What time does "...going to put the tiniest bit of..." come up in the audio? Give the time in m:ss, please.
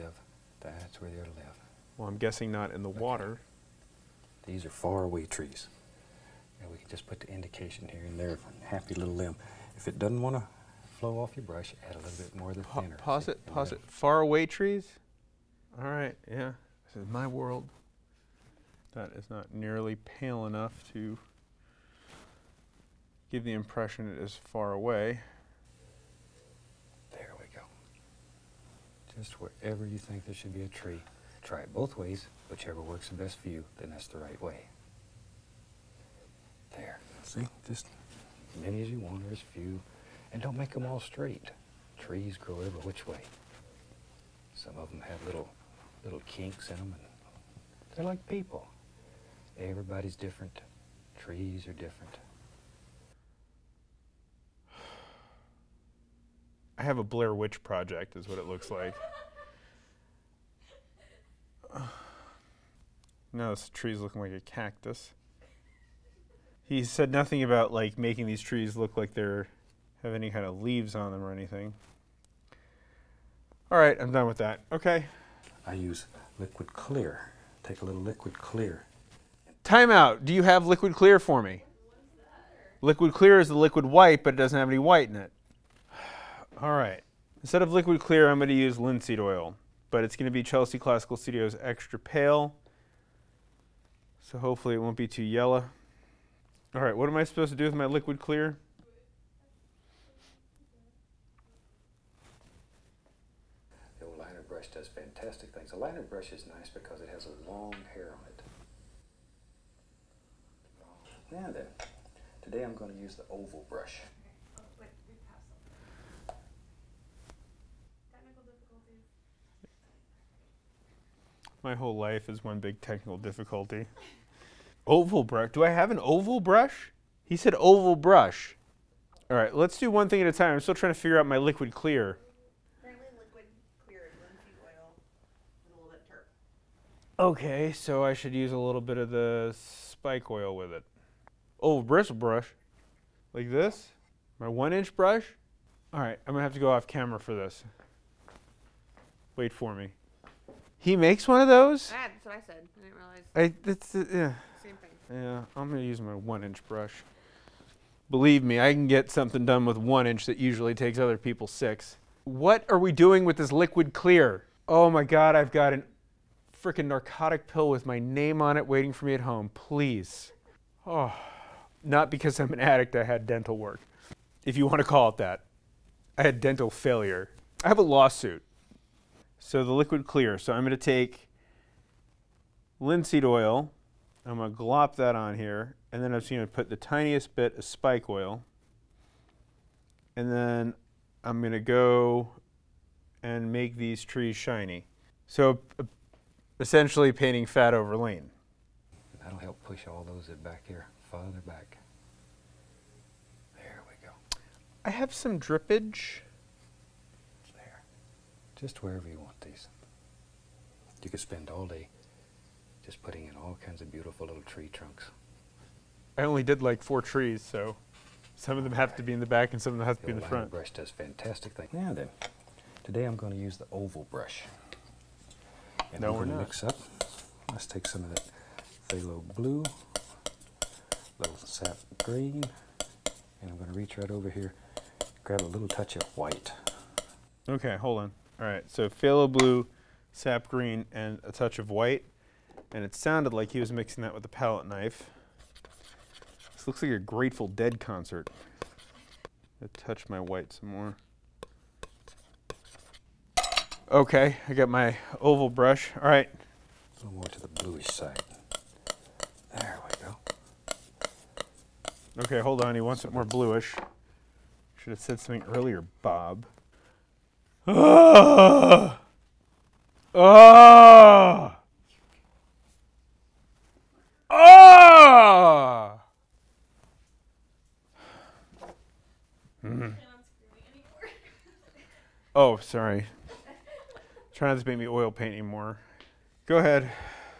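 3:06.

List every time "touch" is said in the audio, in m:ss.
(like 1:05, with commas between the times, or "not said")
3:55, 4:01, 4:09.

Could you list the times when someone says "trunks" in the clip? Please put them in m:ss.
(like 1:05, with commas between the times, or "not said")
3:34.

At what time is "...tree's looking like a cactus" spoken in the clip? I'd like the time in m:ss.
1:03.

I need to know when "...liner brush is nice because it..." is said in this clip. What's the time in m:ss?
1:45.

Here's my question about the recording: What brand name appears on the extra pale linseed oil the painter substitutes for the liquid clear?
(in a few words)
Chelsea Classical Studios.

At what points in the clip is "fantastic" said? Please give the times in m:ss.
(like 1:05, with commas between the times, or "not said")
1:44, 3:40.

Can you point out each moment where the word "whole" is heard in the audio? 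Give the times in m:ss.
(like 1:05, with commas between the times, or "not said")
2:01.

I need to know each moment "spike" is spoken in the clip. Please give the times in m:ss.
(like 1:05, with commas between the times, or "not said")
2:19, 3:07.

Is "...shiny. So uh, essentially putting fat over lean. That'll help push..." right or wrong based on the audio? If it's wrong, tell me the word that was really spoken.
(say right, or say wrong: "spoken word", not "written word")
wrong: "painting", not "putting".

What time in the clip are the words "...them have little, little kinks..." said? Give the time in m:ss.
0:44.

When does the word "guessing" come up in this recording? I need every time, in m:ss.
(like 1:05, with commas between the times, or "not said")
0:02.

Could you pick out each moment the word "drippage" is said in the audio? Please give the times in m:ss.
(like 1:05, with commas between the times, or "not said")
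3:25.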